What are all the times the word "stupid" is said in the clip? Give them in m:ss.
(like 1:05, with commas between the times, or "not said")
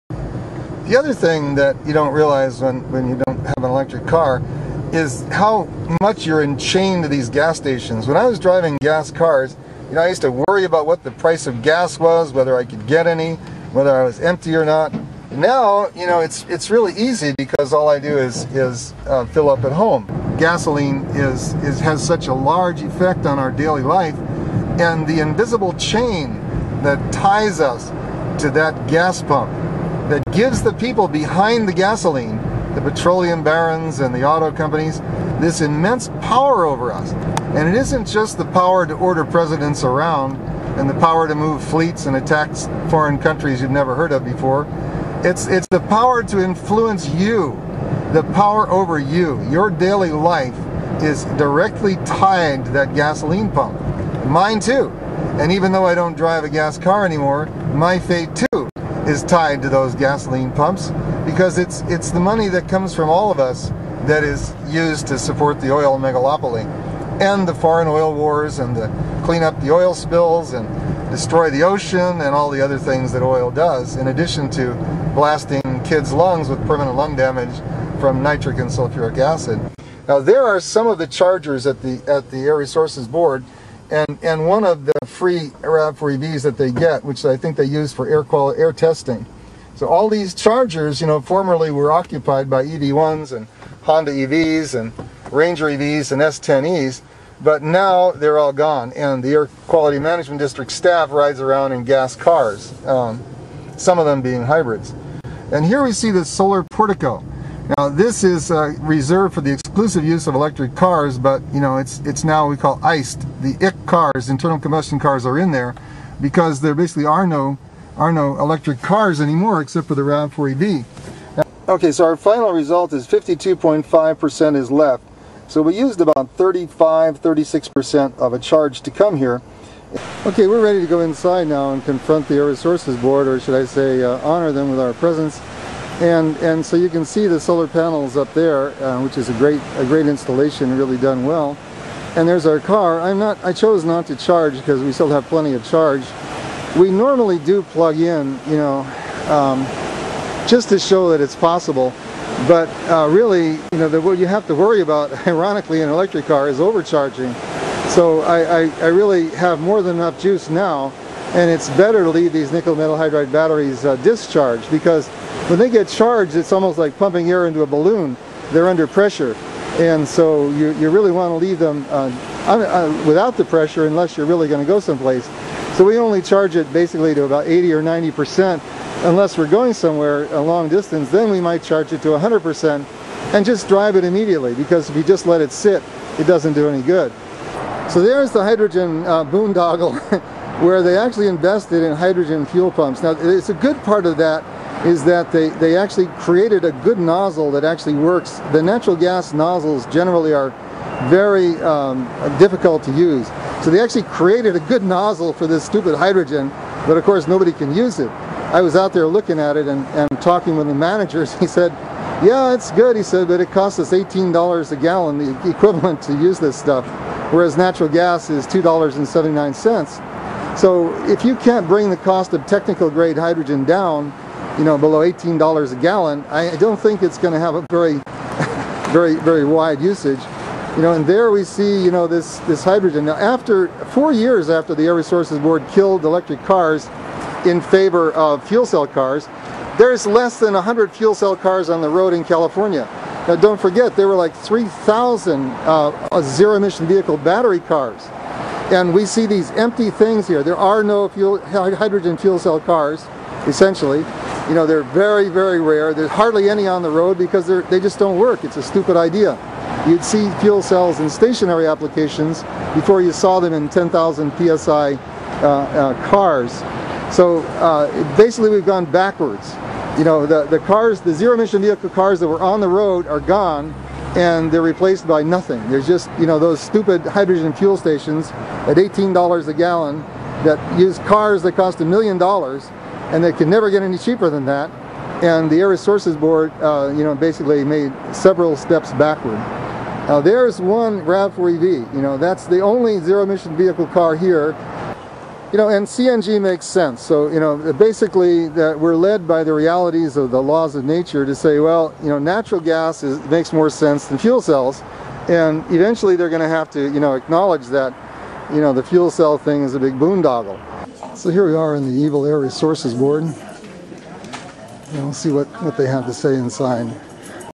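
3:25, 4:18, 4:36.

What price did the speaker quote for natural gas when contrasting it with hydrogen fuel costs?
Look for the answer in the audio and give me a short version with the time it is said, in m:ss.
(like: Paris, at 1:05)
$2.79, at 3:38.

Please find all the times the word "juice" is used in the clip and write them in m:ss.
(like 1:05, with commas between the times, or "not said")
2:40.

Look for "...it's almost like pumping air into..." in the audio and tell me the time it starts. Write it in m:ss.
2:46.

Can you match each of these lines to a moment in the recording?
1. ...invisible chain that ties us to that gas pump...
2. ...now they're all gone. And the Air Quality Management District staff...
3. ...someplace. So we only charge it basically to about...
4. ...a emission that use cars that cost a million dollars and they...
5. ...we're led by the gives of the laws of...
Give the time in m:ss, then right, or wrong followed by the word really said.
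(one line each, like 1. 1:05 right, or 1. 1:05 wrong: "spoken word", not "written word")
1. 0:25 right
2. 1:37 right
3. 2:54 right
4. 4:39 wrong: "gallon", not "emission"
5. 4:58 wrong: "realities", not "gives".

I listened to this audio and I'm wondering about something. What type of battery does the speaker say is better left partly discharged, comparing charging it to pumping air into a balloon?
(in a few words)
nickel metal hydride.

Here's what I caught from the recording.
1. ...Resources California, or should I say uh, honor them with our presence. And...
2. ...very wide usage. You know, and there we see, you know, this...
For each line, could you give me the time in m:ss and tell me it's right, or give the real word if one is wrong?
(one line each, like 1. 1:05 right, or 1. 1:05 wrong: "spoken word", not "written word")
1. 2:12 wrong: "Board", not "California"
2. 3:49 right.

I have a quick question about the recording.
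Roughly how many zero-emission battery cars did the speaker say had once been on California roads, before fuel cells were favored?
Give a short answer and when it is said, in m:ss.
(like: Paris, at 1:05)
3,000, at 4:04.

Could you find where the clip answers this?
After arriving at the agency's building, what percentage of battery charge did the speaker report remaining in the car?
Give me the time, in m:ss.
2:03.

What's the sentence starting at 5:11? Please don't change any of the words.
So here we are in the Evil Air Resources Board.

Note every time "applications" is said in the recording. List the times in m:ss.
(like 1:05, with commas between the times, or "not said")
4:21.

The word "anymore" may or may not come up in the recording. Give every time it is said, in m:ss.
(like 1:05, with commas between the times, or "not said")
0:57, 1:59.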